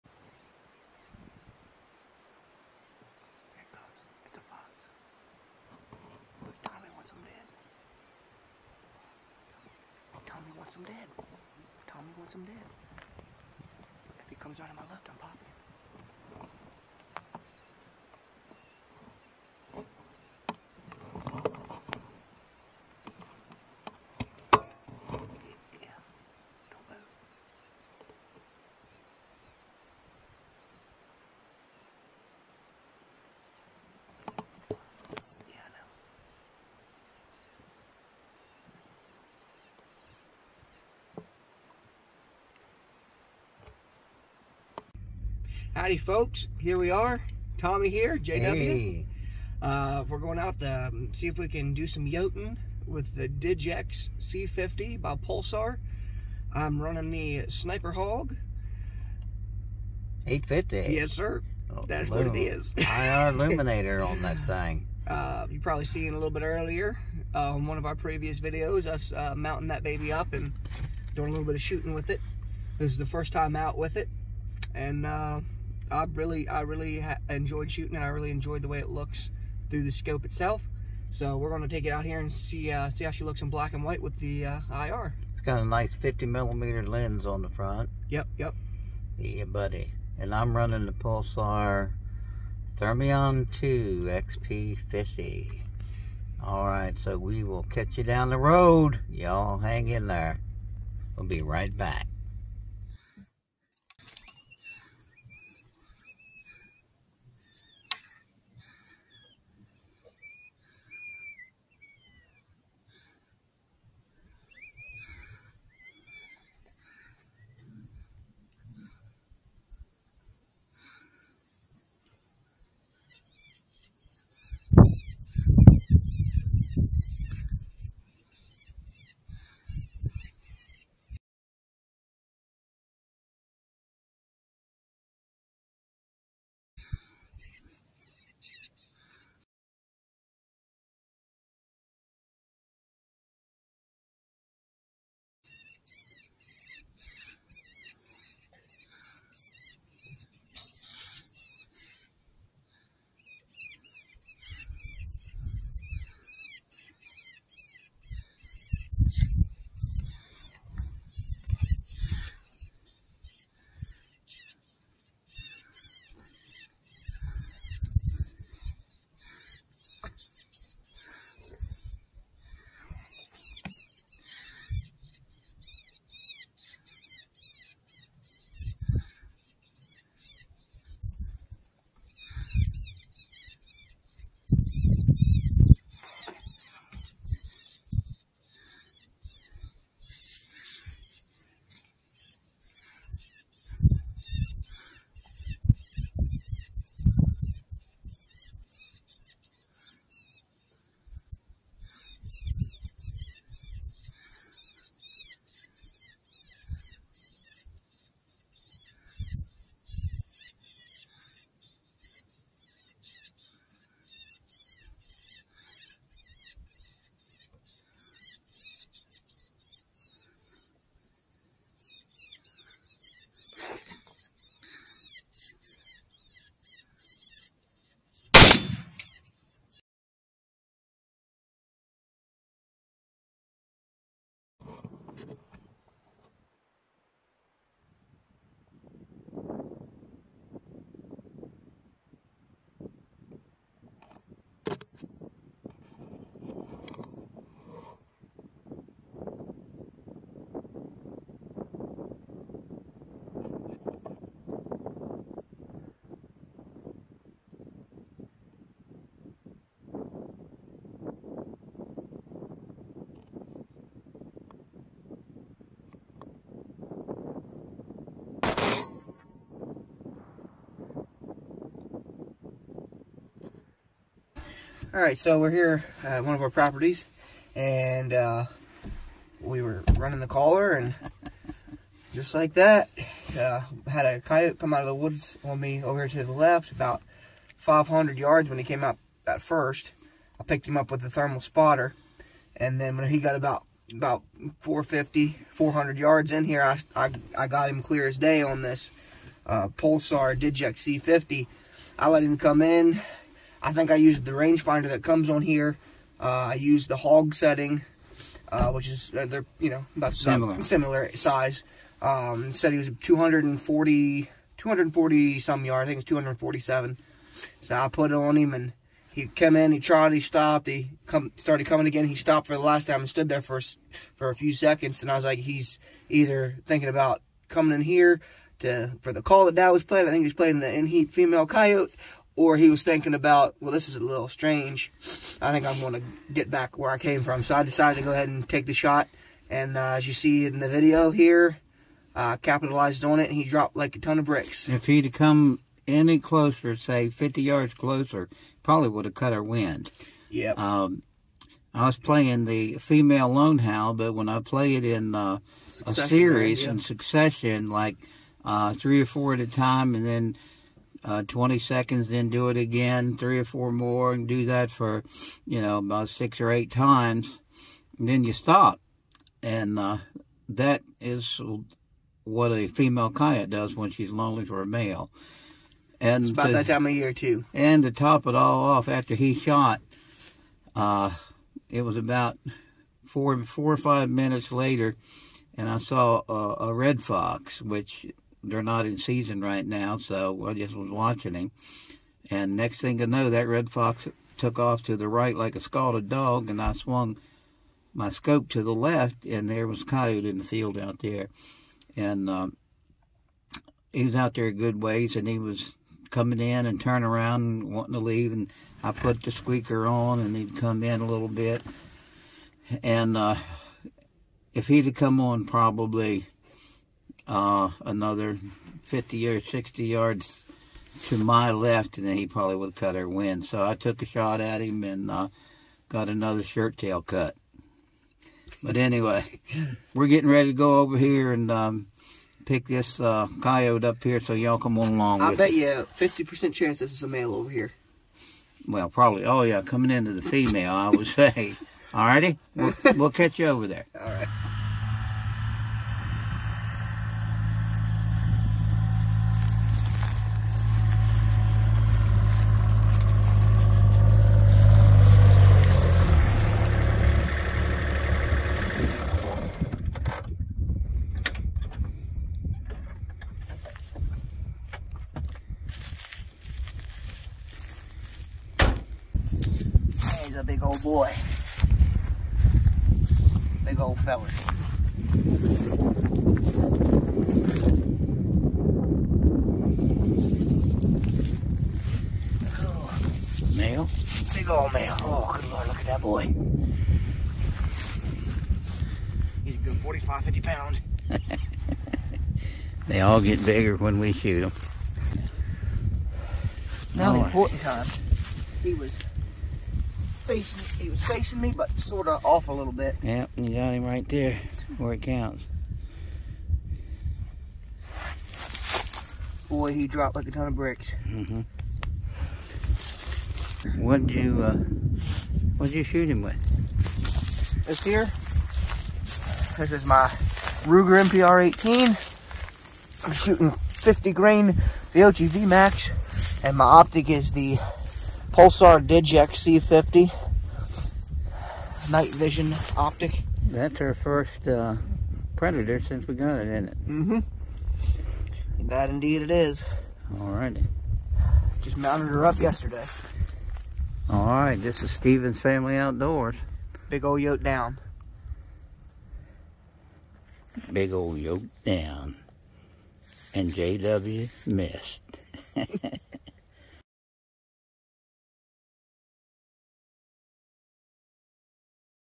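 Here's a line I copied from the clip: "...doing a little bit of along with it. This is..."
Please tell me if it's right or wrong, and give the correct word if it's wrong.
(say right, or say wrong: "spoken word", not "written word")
wrong: "shooting", not "along".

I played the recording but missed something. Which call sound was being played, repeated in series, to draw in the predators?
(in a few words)
female lone howl.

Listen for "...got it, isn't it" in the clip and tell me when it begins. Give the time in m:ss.
8:56.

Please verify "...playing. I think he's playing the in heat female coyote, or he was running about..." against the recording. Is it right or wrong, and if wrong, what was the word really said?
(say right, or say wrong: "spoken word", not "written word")
wrong: "thinking", not "running".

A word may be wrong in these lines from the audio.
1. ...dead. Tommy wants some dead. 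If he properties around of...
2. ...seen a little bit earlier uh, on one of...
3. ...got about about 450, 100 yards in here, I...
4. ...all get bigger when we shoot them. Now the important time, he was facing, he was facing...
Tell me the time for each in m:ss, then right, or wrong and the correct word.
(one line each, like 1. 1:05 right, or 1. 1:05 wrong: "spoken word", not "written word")
1. 0:10 wrong: "comes", not "properties"
2. 1:05 right
3. 4:53 wrong: "400", not "100"
4. 8:13 right.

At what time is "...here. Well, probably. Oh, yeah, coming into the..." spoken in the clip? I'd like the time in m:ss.
7:17.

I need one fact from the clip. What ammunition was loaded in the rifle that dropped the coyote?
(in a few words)
50 grain V-Max.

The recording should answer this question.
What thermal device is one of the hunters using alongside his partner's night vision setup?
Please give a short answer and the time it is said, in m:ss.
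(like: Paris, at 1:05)
Pulsar Thermion 2 XP50, at 1:30.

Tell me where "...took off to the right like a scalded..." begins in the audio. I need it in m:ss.
6:34.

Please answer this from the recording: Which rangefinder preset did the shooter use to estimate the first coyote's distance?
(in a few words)
hog setting.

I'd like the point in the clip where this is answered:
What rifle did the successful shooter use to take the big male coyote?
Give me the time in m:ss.
8:40.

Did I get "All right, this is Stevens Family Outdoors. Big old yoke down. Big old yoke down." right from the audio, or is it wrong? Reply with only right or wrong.
right.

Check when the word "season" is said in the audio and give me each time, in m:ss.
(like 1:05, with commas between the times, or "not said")
6:28.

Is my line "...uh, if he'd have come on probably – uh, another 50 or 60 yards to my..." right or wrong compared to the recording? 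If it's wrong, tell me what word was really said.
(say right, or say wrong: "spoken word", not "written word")
right.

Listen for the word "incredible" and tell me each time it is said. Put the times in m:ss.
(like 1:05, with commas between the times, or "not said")
not said.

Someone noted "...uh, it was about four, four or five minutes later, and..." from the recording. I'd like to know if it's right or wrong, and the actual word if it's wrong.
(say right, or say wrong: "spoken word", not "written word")
right.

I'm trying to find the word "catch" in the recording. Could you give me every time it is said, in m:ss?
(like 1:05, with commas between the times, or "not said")
1:37, 7:23.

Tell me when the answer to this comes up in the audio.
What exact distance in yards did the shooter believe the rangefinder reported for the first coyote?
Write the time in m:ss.
5:16.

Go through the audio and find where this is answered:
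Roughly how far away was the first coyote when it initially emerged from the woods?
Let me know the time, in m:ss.
4:46.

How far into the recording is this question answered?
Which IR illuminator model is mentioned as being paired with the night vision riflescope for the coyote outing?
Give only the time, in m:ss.
0:57.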